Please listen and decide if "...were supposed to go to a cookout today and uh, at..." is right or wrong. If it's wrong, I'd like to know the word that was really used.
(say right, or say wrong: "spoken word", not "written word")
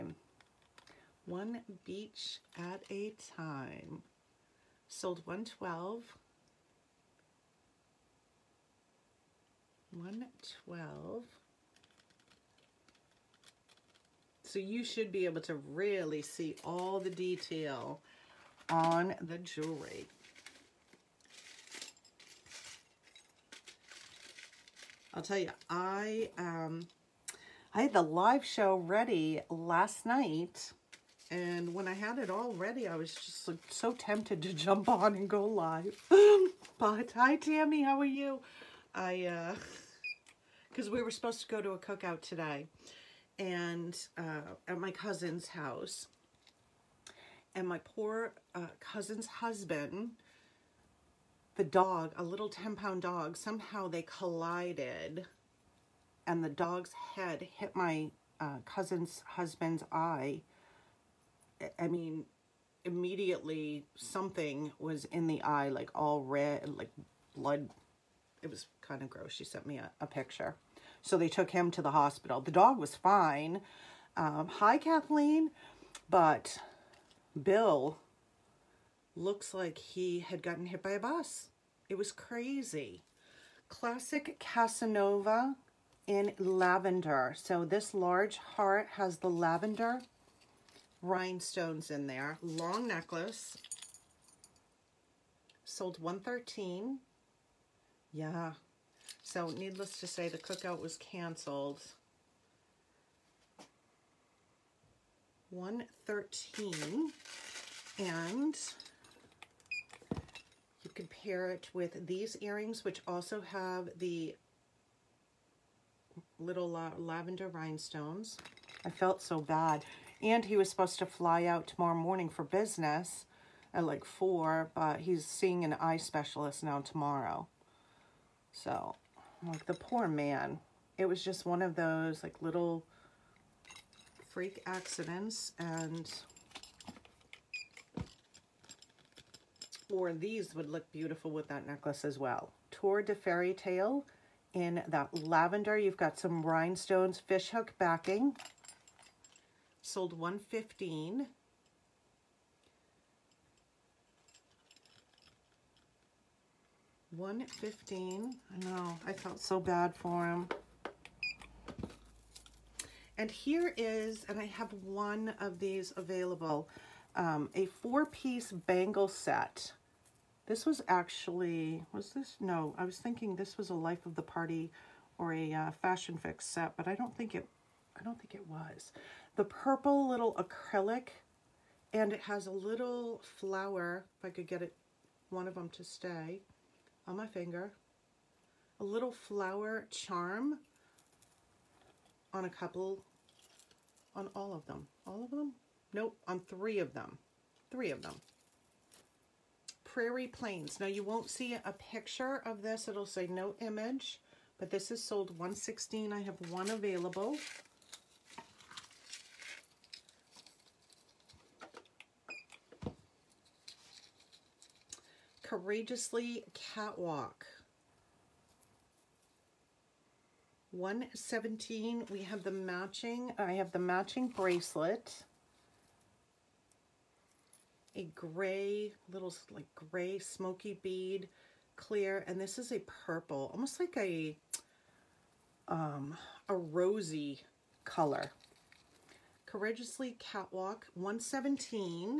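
right.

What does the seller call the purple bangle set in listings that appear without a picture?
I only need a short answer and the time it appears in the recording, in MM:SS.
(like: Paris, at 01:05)
Prairie Plains, at 03:19.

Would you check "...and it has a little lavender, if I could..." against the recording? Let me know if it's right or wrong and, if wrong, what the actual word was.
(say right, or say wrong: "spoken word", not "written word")
wrong: "flower", not "lavender".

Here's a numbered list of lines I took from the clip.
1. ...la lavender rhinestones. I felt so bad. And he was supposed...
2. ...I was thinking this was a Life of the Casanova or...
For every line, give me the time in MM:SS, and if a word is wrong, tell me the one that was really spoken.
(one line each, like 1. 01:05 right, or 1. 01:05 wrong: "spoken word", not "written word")
1. 01:56 right
2. 02:52 wrong: "Party", not "Casanova".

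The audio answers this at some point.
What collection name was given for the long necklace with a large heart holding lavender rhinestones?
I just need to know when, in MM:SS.
01:23.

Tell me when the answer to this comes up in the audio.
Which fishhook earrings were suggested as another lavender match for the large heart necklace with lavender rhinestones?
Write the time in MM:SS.
02:22.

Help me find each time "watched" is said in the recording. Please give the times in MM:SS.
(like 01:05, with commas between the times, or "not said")
not said.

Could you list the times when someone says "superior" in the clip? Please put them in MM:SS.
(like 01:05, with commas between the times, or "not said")
not said.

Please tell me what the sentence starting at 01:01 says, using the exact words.
I mean, immediately something was in the eye, like all red, like blood it was kind of gross.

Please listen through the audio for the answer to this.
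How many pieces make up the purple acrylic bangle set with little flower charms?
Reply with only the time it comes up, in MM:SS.
02:47.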